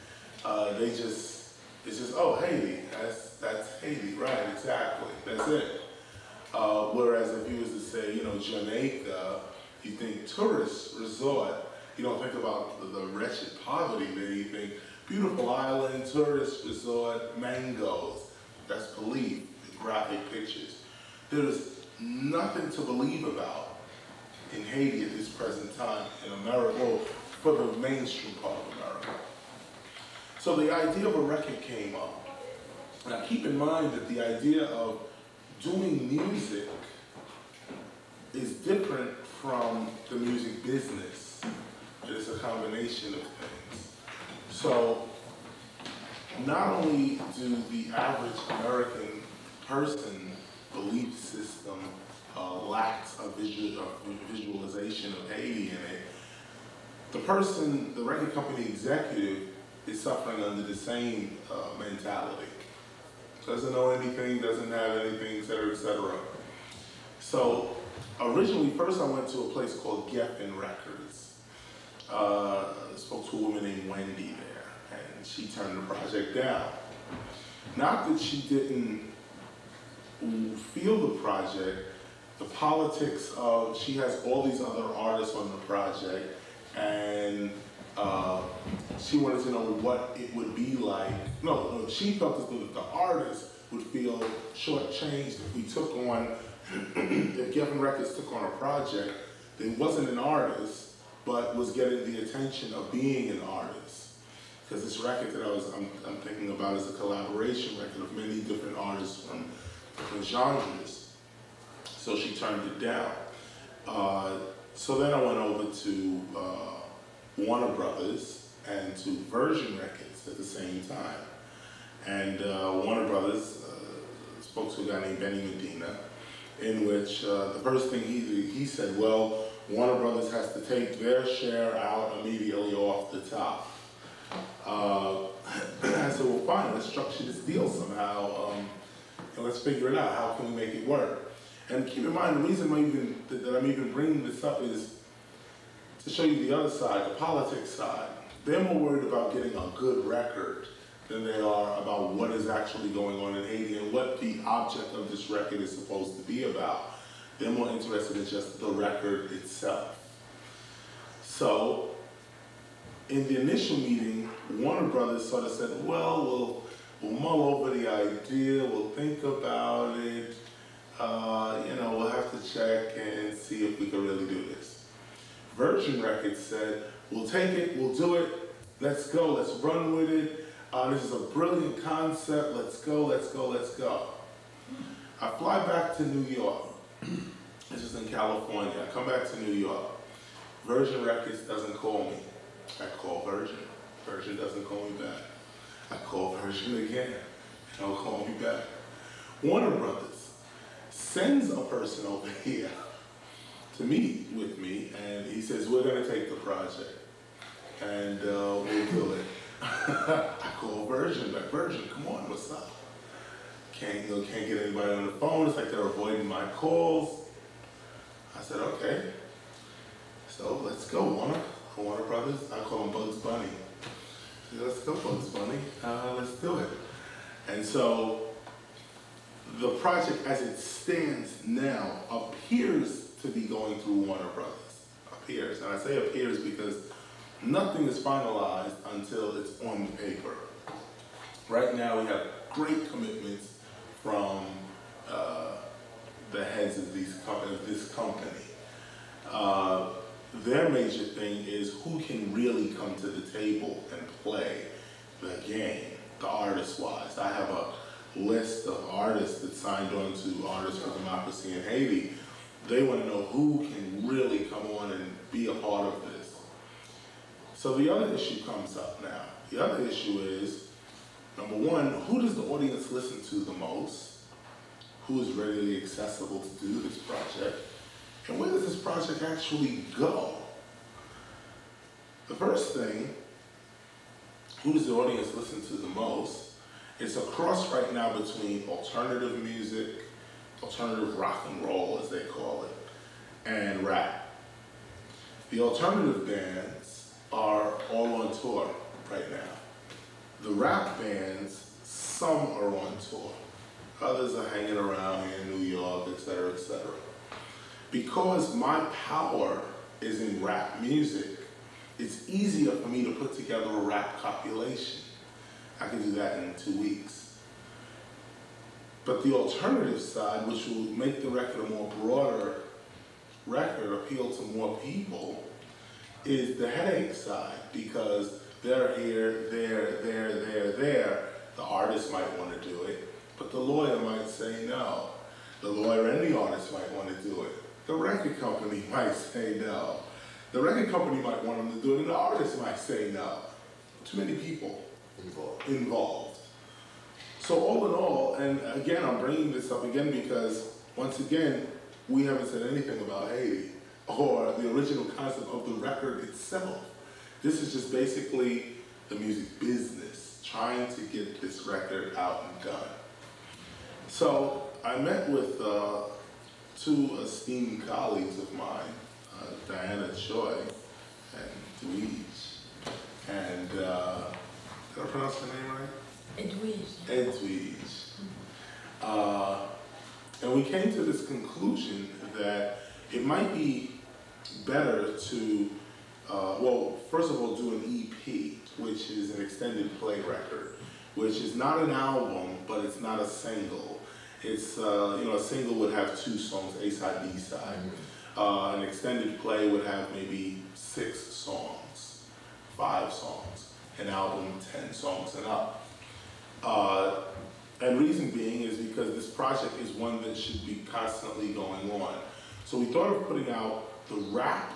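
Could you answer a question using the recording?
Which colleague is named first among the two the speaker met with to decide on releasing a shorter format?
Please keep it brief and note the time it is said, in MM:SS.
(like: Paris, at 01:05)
Diana Choi, at 06:09.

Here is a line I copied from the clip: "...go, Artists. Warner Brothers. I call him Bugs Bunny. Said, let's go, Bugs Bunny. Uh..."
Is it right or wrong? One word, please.
wrong.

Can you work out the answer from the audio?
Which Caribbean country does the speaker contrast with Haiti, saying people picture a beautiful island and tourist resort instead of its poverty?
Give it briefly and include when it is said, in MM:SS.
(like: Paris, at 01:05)
Jamaica, at 00:08.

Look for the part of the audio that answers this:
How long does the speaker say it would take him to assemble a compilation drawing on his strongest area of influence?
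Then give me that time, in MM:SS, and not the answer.
05:16.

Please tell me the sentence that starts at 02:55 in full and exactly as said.
Virgin Records said, we'll take it, we'll do it, let's go, let's run with it.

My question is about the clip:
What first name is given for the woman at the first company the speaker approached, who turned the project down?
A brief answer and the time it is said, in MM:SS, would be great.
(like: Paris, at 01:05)
Wendy, at 01:13.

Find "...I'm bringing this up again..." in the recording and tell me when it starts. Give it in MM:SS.
05:49.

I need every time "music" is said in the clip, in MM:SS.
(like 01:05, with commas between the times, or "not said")
00:36, 00:40, 04:49, 05:10, 05:59.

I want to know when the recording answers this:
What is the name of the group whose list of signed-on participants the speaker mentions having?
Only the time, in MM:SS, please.
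04:20.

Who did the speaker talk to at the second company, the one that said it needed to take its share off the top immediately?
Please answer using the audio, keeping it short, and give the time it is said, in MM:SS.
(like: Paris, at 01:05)
Benny Medina, at 02:05.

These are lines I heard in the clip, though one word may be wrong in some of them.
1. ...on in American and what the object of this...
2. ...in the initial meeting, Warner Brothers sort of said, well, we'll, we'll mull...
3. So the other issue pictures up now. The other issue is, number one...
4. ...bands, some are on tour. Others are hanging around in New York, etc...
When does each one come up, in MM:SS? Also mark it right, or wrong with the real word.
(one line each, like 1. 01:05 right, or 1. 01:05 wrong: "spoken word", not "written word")
1. 02:33 wrong: "Haiti", not "American"
2. 02:43 right
3. 04:27 wrong: "comes", not "pictures"
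4. 05:00 right.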